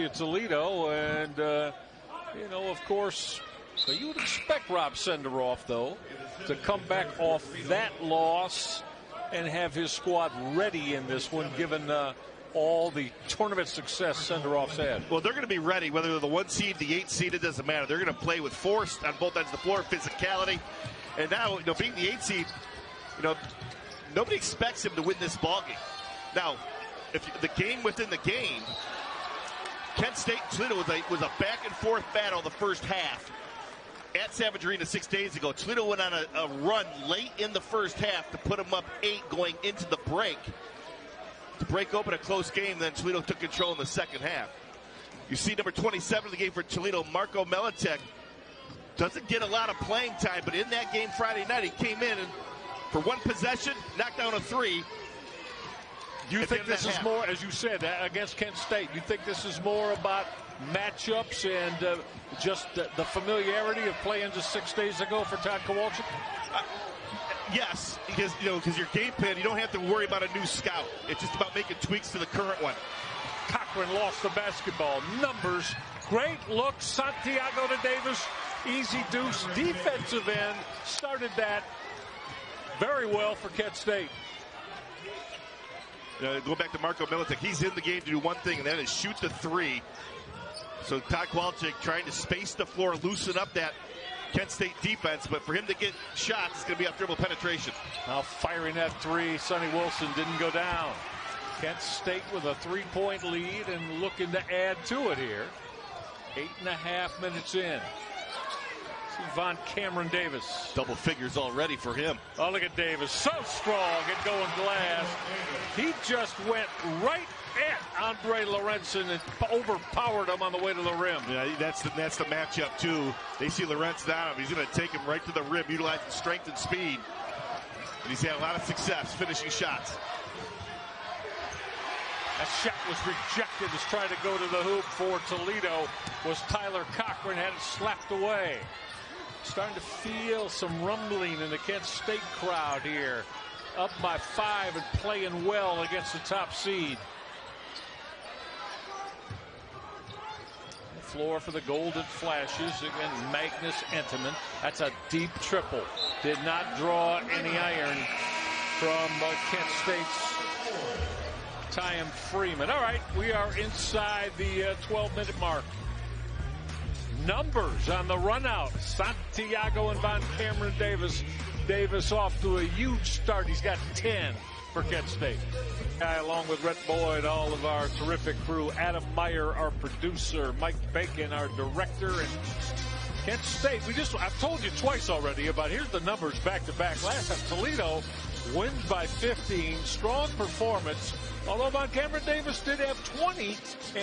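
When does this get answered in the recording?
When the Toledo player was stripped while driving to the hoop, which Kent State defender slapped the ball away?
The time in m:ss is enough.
2:16.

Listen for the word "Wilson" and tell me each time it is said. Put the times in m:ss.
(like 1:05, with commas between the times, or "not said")
1:39.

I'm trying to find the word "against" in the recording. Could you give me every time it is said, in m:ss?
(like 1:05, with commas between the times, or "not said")
0:58, 2:25, 2:32.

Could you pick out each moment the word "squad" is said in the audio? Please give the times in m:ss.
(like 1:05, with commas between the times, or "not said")
0:09.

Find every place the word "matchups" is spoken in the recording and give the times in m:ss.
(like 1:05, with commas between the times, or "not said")
1:00, 2:02.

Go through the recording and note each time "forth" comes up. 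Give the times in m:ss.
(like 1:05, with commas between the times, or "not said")
0:31.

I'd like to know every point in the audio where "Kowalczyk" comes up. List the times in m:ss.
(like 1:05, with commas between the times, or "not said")
1:05, 1:31.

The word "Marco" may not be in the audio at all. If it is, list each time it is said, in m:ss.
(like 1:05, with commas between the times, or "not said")
0:47, 1:26.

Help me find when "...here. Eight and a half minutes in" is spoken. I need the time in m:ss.
1:45.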